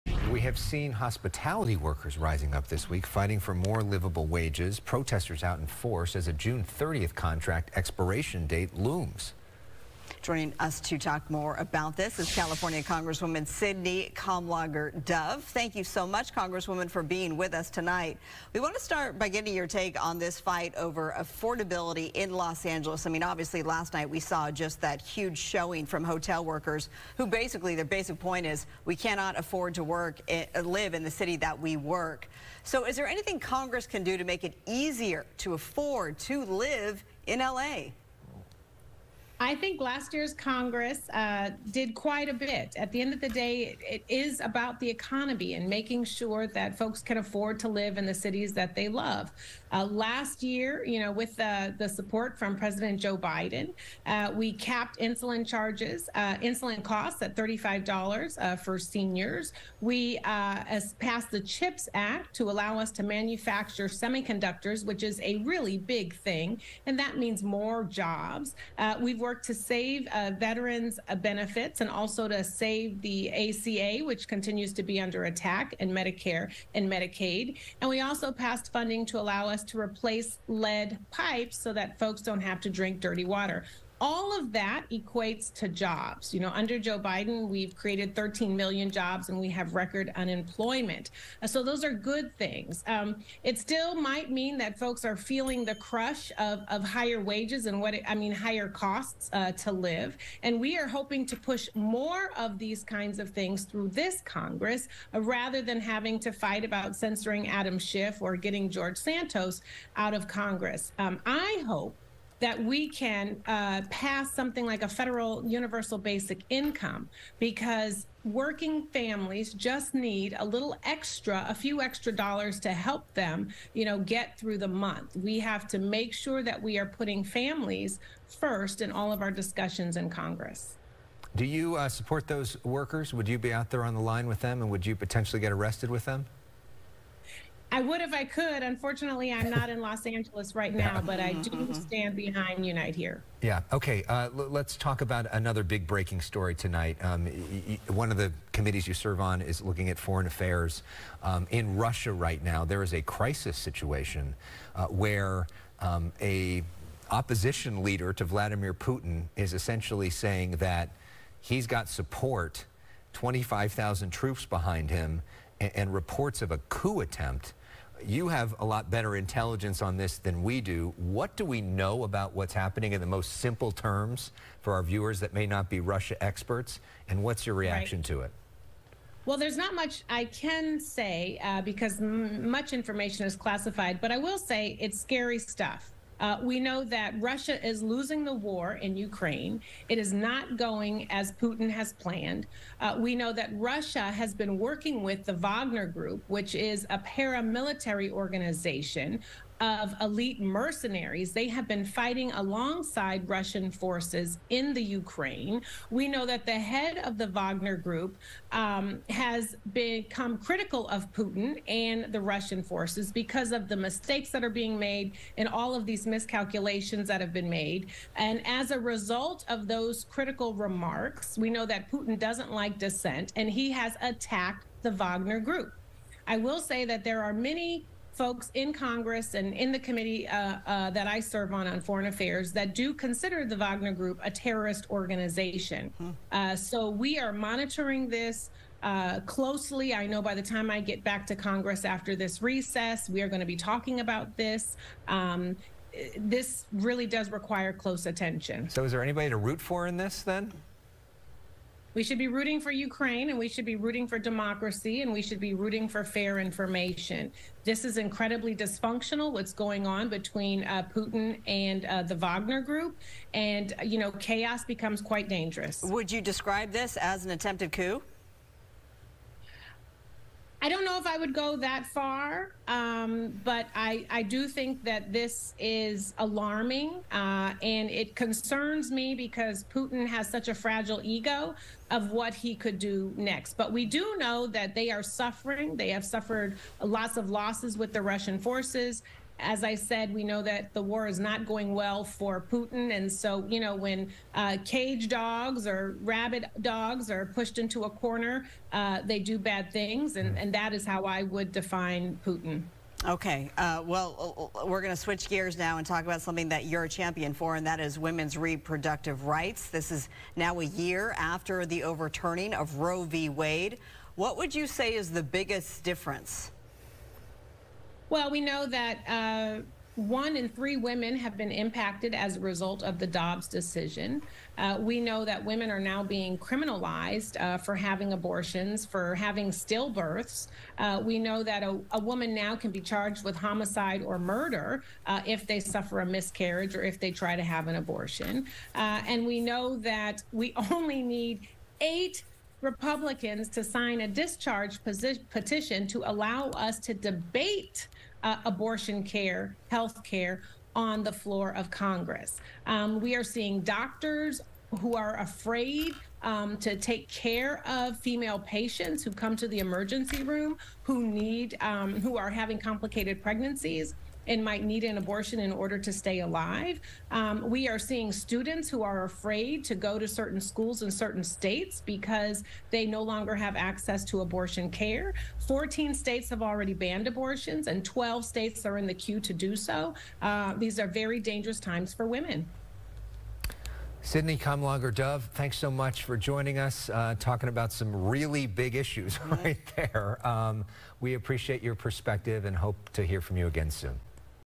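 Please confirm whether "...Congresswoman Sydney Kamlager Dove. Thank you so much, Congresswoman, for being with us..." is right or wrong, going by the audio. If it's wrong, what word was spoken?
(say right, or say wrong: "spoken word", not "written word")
right.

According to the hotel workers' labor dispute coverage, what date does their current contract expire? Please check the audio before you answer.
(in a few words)
June 30th.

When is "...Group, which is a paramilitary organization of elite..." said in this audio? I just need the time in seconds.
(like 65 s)
195 s.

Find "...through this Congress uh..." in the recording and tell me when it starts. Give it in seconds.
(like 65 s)
103 s.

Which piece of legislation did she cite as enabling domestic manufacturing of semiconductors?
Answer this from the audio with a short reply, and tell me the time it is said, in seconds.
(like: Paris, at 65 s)
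CHIPS Act, at 61 s.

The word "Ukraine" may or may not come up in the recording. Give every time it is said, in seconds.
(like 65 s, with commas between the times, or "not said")
188 s, 204 s, 252 s.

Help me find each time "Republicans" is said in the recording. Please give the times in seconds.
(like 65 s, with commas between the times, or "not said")
342 s.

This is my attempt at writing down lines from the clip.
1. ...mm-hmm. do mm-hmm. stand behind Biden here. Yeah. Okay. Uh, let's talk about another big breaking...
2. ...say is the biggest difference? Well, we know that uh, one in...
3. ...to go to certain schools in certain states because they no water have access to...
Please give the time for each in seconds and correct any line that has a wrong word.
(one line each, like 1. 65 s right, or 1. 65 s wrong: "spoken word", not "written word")
1. 141 s wrong: "Unite", not "Biden"
2. 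314 s right
3. 369 s wrong: "longer", not "water".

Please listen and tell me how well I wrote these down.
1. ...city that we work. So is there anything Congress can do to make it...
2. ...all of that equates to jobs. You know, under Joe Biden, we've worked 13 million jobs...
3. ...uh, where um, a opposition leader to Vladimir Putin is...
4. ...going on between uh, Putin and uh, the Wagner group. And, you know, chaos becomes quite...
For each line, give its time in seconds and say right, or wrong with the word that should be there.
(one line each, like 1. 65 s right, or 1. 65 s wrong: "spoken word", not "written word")
1. 31 s right
2. 84 s wrong: "created", not "worked"
3. 154 s right
4. 259 s right.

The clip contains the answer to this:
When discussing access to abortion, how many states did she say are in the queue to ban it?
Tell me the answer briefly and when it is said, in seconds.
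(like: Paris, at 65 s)
12, at 377 s.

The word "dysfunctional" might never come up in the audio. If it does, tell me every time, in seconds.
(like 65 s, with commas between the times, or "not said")
258 s.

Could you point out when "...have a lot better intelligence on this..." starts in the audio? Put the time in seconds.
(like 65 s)
168 s.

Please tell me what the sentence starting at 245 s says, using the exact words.
Um, this really does require close attention.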